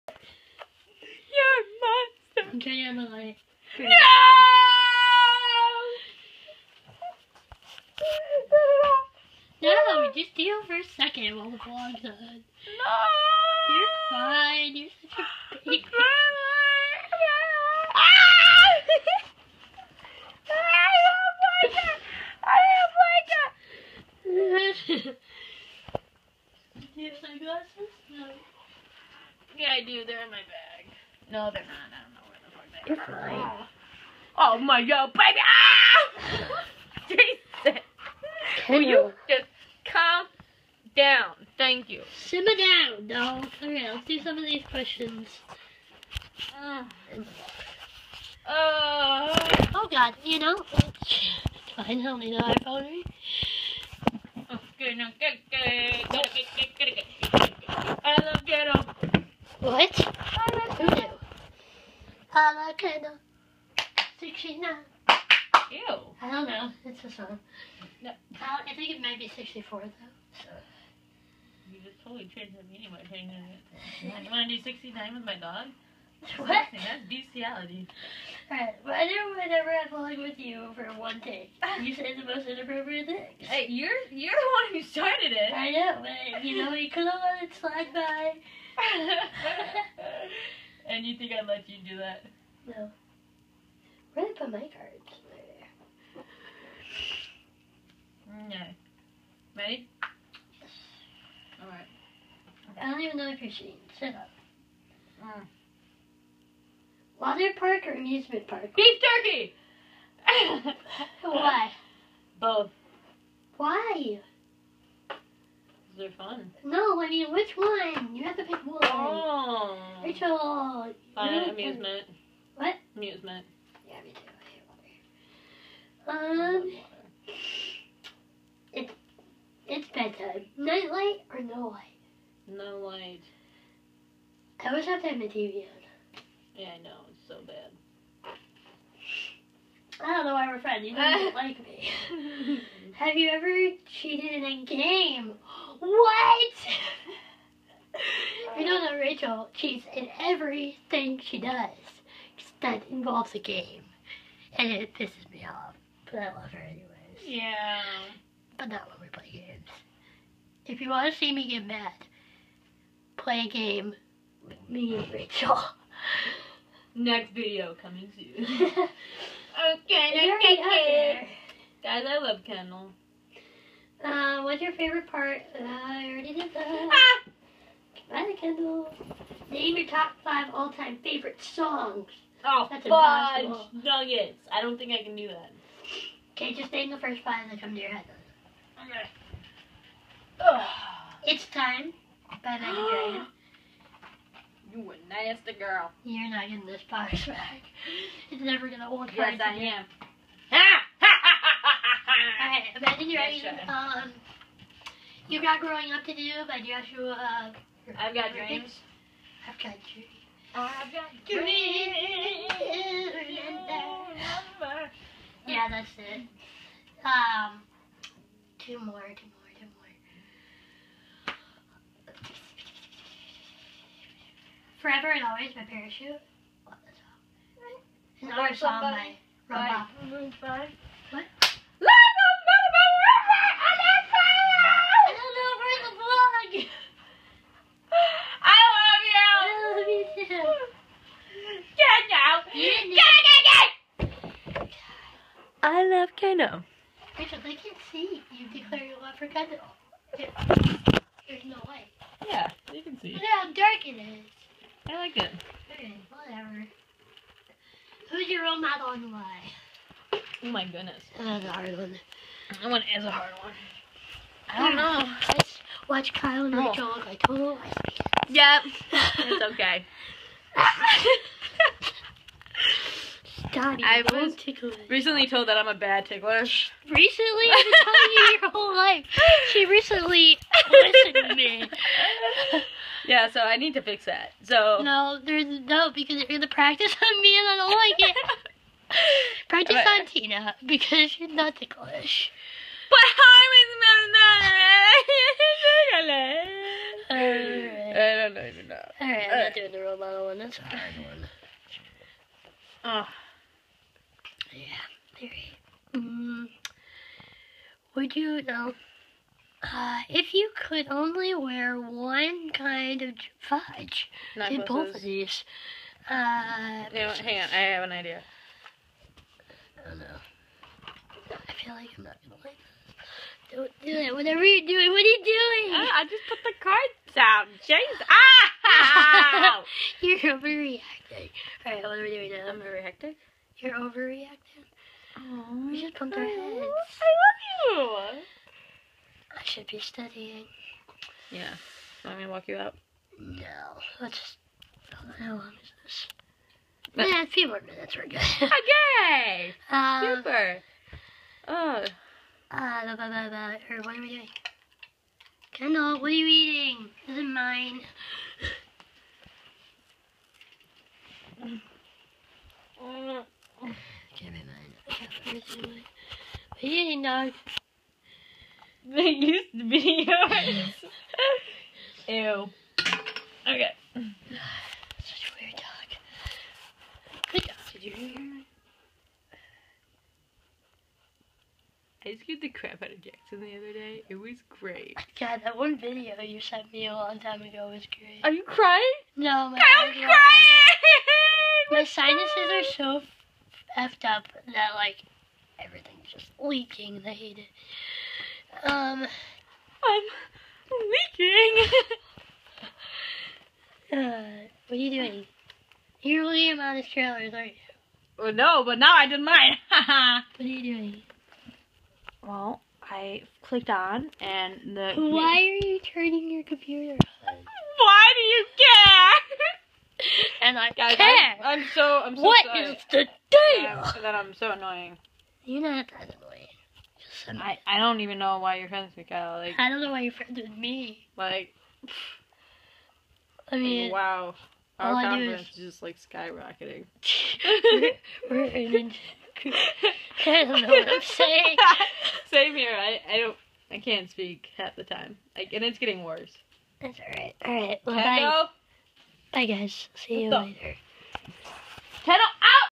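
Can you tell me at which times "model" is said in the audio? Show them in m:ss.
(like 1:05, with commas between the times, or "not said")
4:18, 4:59.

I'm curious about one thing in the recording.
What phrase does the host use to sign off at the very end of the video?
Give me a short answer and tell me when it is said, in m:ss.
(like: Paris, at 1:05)
Kendall out, at 7:32.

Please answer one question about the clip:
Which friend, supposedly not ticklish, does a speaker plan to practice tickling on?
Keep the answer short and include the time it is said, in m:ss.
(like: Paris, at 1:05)
Tina, at 4:50.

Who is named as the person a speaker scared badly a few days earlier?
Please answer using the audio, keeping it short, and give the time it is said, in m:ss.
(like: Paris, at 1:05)
Jackson, at 6:23.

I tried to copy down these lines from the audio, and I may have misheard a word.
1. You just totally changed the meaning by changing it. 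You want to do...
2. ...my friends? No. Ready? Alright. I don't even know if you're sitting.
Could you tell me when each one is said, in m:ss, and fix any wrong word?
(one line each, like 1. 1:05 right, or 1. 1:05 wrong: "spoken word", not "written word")
1. 1:11 right
2. 1:34 wrong: "cards", not "friends".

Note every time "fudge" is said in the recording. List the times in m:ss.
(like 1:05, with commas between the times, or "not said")
3:03, 5:13.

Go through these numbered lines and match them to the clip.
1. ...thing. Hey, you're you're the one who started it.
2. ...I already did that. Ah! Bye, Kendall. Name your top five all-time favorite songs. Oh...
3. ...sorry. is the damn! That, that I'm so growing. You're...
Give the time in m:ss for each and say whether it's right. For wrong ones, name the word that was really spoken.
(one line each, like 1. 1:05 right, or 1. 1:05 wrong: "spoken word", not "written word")
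1. 1:23 right
2. 2:55 right
3. 7:02 wrong: "annoying", not "growing".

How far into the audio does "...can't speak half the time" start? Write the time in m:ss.
7:23.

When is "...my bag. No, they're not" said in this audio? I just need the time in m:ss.
0:30.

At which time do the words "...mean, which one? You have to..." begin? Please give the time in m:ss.
1:57.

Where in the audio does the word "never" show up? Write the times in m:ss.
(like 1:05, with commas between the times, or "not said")
1:19, 3:18.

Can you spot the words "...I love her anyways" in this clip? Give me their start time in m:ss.
2:36.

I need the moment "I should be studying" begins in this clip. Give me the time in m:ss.
5:39.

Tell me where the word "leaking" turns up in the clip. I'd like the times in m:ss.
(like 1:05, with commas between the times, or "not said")
6:36, 6:41.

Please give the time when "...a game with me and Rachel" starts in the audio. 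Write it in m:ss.
2:43.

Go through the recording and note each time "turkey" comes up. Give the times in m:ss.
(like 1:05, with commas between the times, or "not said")
1:49.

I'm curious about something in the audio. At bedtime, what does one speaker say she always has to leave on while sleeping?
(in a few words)
TV.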